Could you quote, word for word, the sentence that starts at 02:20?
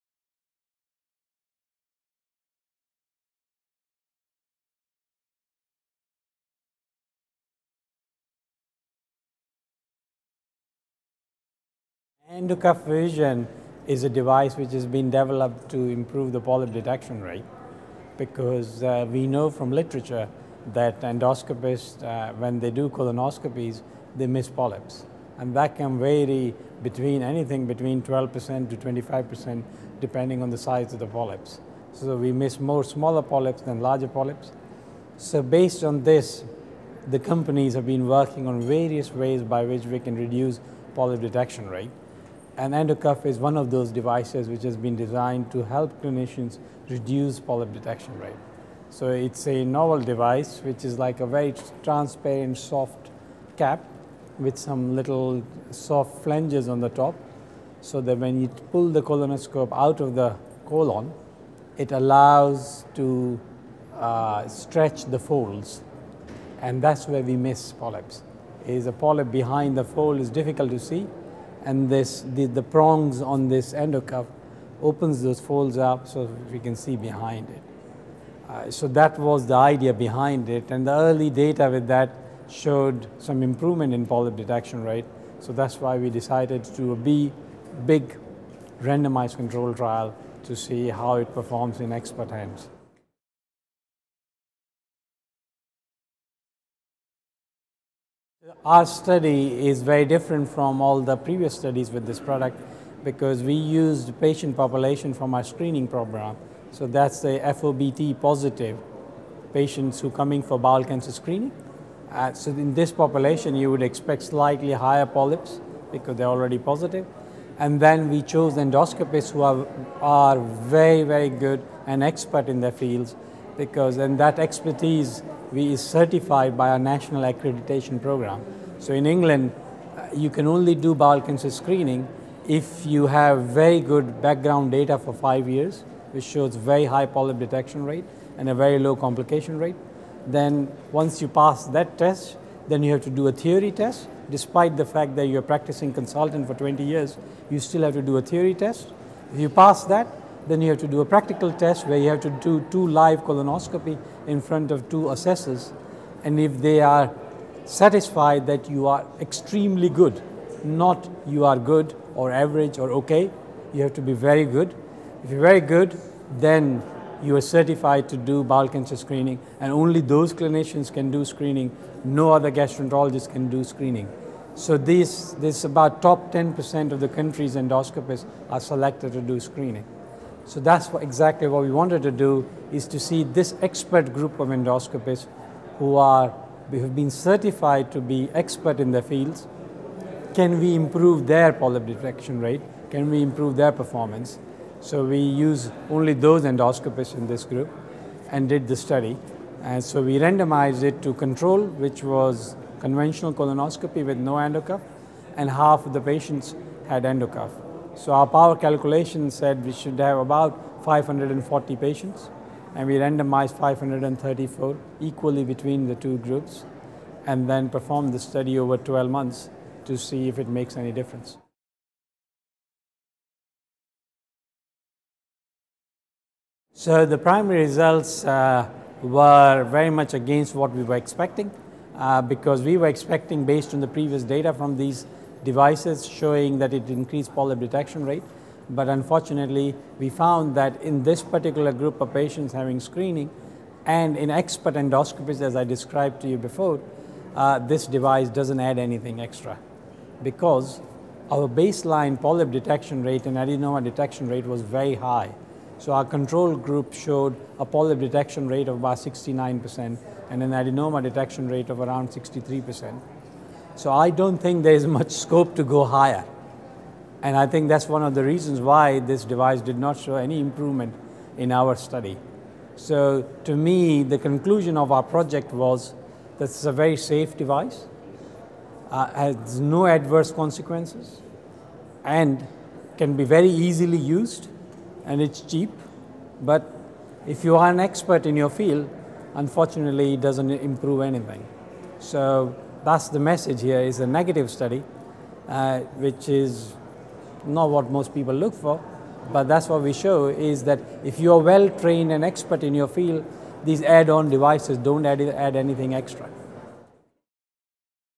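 Then once you pass that test, then you have to do a theory test.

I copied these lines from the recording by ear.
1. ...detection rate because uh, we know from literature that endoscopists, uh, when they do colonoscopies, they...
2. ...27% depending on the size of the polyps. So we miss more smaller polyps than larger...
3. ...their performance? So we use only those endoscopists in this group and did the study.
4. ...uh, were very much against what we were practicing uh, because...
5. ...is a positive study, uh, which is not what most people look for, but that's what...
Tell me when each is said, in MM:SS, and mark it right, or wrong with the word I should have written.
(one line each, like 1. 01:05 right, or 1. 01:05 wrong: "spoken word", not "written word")
1. 00:16 right
2. 00:28 wrong: "25", not "27"
3. 03:13 right
4. 03:48 wrong: "expecting", not "practicing"
5. 04:53 wrong: "negative", not "positive".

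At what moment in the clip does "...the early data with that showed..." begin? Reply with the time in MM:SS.
01:20.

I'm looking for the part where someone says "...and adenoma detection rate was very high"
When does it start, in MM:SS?
04:13.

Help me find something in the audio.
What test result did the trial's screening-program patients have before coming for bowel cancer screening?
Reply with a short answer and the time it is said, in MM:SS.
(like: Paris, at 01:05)
FOBT positive, at 01:47.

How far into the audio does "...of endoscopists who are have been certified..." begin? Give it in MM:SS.
03:04.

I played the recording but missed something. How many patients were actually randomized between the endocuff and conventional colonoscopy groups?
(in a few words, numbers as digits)
534.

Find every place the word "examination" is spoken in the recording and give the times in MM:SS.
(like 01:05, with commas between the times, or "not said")
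not said.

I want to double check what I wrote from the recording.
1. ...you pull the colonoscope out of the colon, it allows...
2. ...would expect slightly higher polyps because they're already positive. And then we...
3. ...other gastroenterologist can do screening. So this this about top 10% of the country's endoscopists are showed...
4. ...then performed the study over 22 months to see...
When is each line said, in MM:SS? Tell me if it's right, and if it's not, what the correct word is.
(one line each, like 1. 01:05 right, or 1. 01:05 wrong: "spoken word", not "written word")
1. 00:58 right
2. 01:53 right
3. 02:52 wrong: "selected", not "showed"
4. 03:37 wrong: "12", not "22".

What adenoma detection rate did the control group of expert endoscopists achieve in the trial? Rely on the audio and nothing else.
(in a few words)
63%.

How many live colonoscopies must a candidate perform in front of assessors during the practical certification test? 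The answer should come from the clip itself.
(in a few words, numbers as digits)
2.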